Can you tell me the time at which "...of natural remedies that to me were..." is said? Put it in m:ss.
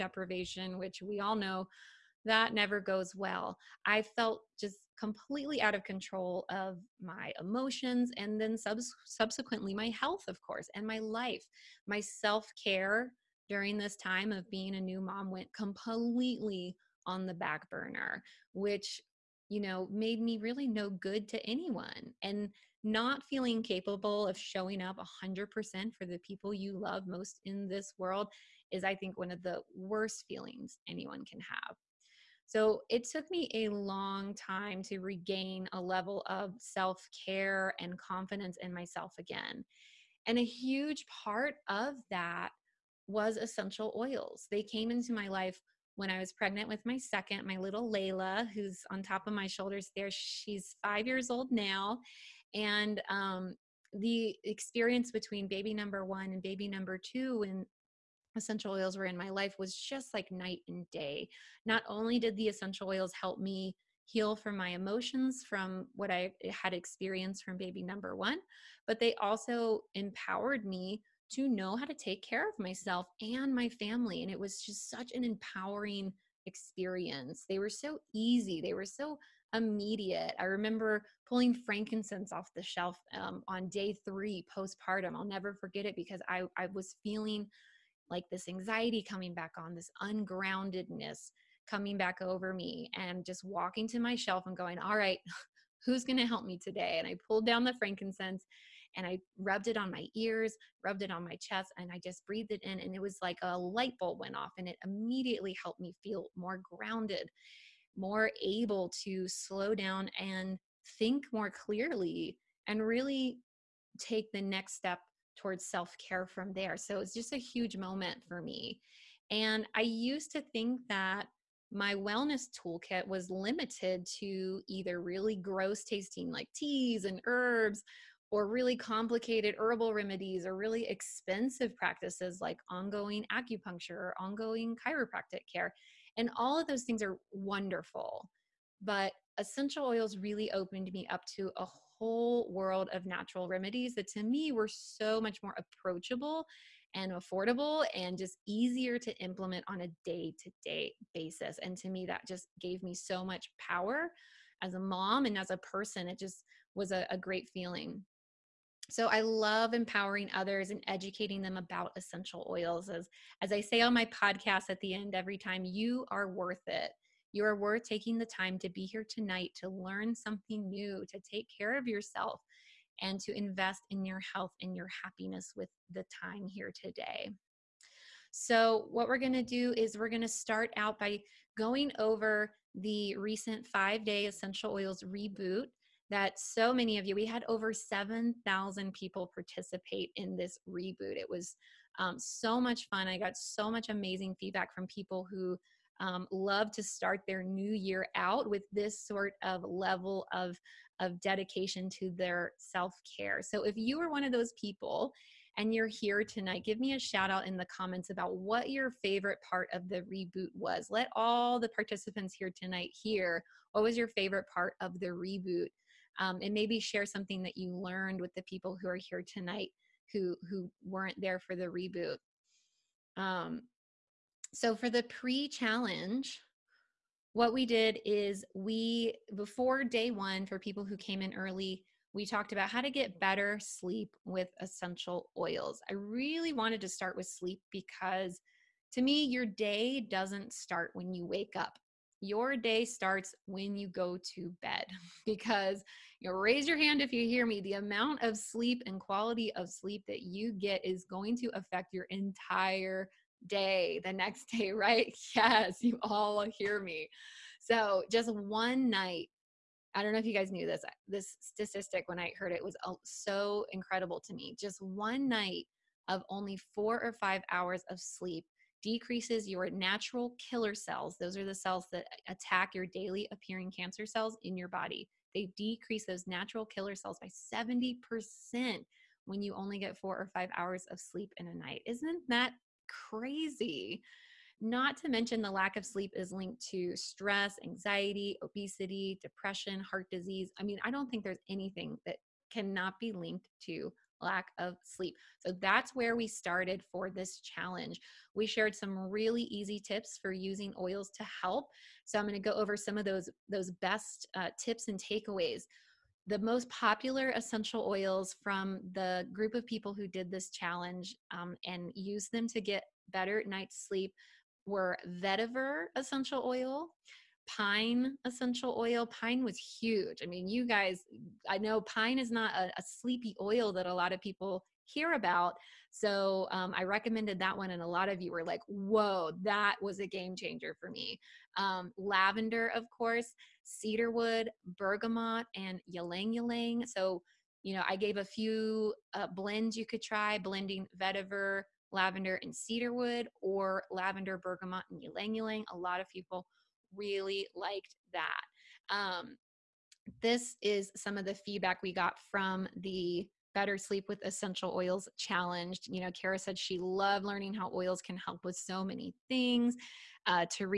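2:22.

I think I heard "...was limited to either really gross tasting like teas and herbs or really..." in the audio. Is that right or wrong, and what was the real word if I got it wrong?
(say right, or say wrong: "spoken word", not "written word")
right.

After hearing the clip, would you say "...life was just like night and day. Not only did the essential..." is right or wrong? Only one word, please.
right.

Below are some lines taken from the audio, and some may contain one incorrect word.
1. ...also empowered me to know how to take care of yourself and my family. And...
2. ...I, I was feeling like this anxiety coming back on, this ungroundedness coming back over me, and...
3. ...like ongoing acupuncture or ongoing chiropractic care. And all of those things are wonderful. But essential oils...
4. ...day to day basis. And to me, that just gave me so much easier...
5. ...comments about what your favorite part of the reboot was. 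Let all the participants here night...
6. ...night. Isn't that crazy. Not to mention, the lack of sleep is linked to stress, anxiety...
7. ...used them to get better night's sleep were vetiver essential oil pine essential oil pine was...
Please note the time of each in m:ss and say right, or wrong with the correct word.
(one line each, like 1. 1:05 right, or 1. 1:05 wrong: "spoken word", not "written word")
1. 1:09 wrong: "myself", not "yourself"
2. 1:26 right
3. 2:12 right
4. 2:30 wrong: "power", not "easier"
5. 3:27 wrong: "tonight", not "night"
6. 4:41 right
7. 5:11 right.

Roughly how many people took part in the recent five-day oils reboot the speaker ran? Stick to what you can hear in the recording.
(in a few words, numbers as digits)
7,000.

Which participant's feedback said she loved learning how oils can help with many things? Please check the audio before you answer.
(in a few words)
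Kara.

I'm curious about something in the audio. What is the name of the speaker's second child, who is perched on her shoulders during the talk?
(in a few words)
Layla.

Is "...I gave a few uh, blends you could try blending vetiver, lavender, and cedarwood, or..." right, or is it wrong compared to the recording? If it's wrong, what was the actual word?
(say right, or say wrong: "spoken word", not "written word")
right.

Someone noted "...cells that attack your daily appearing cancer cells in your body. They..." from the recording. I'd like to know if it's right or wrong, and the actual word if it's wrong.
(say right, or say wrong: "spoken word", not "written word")
right.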